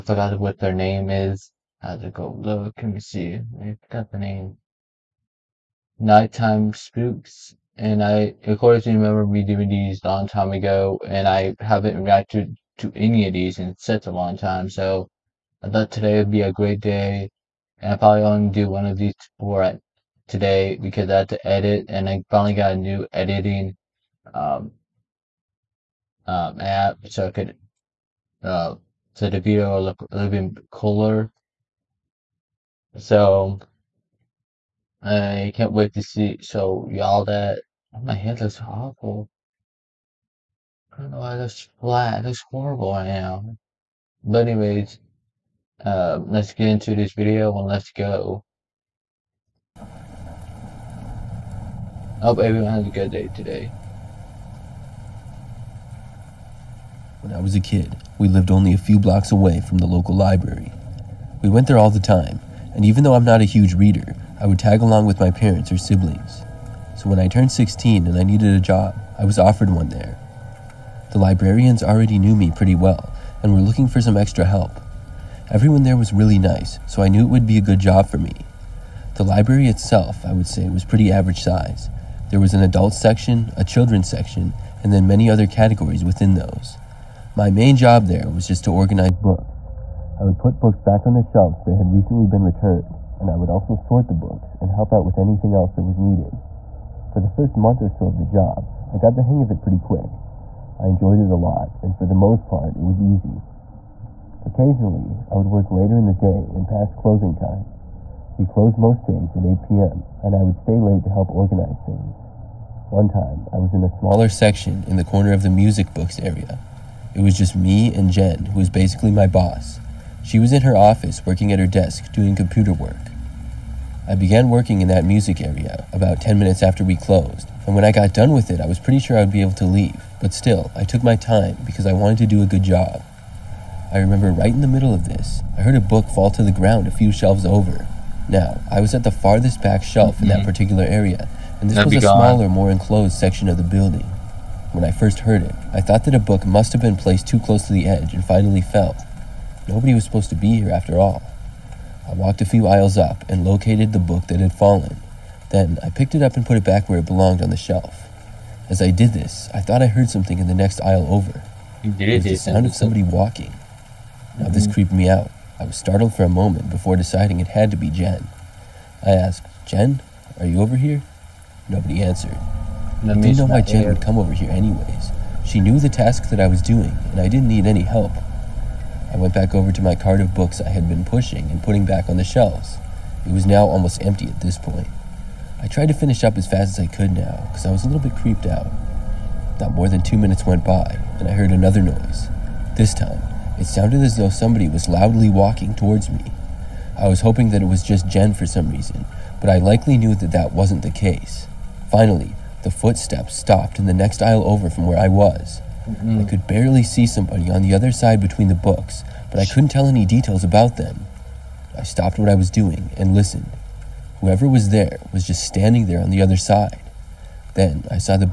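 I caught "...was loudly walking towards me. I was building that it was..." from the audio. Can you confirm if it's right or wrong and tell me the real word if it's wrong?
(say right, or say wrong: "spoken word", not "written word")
wrong: "hoping", not "building".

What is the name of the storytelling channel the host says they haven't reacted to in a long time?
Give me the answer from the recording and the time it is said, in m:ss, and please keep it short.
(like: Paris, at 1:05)
Nighttime Spooks, at 0:05.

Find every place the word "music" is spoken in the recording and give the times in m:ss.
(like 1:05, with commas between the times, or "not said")
1:55, 2:05.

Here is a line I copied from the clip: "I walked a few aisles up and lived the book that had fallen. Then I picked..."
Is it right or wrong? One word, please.
wrong.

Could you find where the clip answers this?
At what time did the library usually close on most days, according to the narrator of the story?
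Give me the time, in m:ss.
1:49.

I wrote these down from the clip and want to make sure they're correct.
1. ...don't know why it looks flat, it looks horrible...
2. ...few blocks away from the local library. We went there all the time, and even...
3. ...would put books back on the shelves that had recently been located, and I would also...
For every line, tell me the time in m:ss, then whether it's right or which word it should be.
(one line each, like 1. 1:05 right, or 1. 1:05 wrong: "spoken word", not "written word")
1. 0:41 right
2. 0:58 right
3. 1:30 wrong: "returned", not "located".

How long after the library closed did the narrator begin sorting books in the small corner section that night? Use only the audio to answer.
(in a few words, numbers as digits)
10 minutes.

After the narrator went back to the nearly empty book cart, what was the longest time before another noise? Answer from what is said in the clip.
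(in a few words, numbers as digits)
2 minutes.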